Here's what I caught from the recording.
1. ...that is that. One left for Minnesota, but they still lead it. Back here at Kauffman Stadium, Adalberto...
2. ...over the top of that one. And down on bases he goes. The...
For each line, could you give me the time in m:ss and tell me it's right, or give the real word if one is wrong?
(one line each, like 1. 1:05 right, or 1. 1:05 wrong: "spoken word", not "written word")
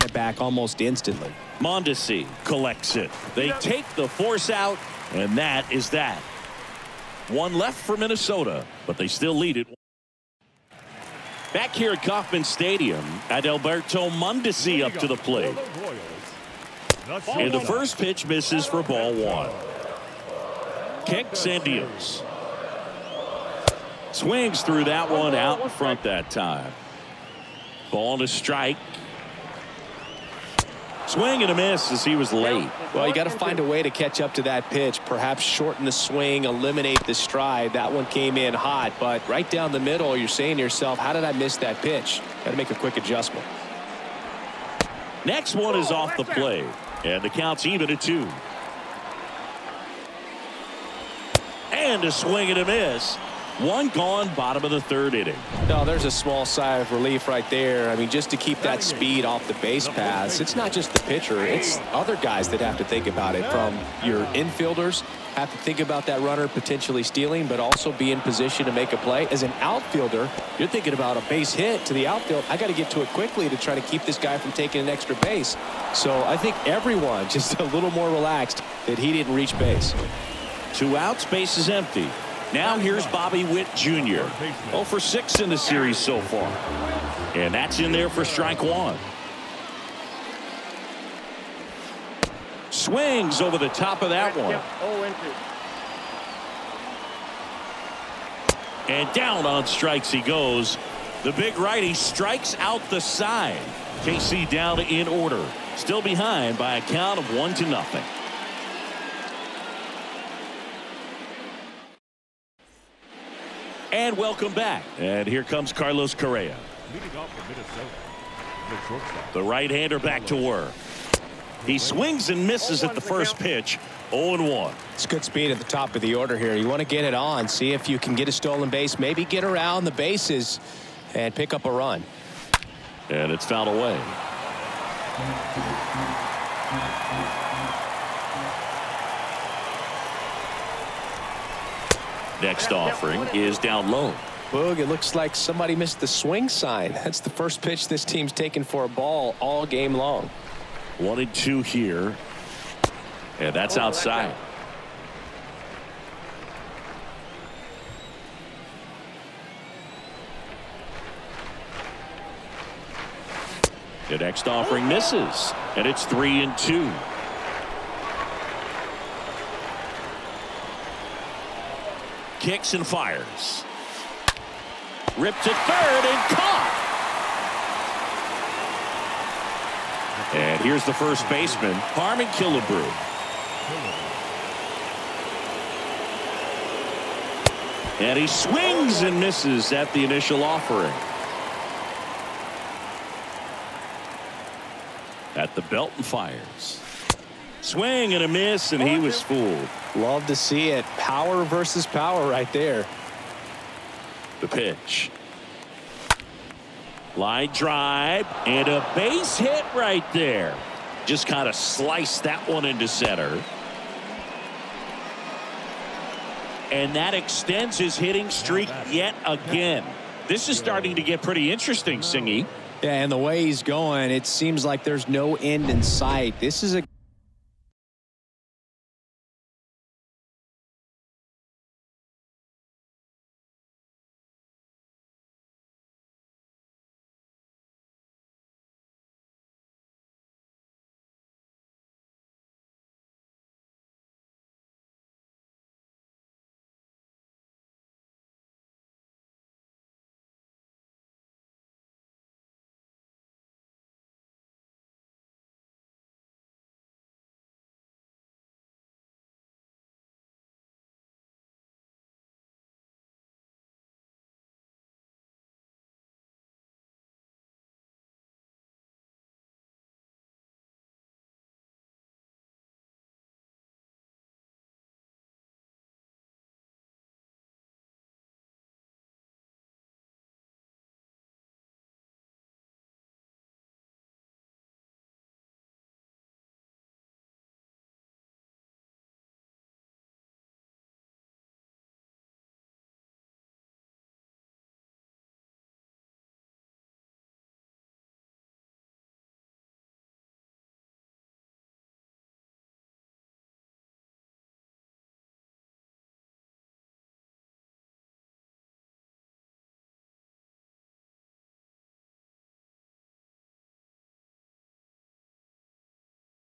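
1. 0:05 right
2. 1:33 wrong: "strikes", not "bases".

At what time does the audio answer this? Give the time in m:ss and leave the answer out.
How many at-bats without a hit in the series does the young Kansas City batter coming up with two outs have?
1:24.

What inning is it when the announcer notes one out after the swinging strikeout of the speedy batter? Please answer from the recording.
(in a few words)
bottom of the third.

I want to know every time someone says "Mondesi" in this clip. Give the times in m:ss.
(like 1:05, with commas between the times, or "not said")
0:01, 0:14.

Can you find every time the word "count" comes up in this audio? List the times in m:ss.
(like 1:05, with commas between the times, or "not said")
0:47, 1:46.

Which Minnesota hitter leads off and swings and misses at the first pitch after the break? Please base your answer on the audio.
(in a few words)
Carlos Correa.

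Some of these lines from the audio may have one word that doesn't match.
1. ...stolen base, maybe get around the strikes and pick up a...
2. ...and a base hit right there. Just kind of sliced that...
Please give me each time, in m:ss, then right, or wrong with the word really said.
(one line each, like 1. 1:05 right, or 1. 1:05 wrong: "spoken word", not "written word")
1. 2:08 wrong: "bases", not "strikes"
2. 3:28 right.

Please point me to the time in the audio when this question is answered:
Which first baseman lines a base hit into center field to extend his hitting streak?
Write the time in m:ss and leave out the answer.
3:01.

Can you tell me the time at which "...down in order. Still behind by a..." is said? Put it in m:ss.
1:44.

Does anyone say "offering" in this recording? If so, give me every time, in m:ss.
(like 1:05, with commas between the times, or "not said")
2:22, 2:44, 3:10.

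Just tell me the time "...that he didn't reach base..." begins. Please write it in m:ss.
1:18.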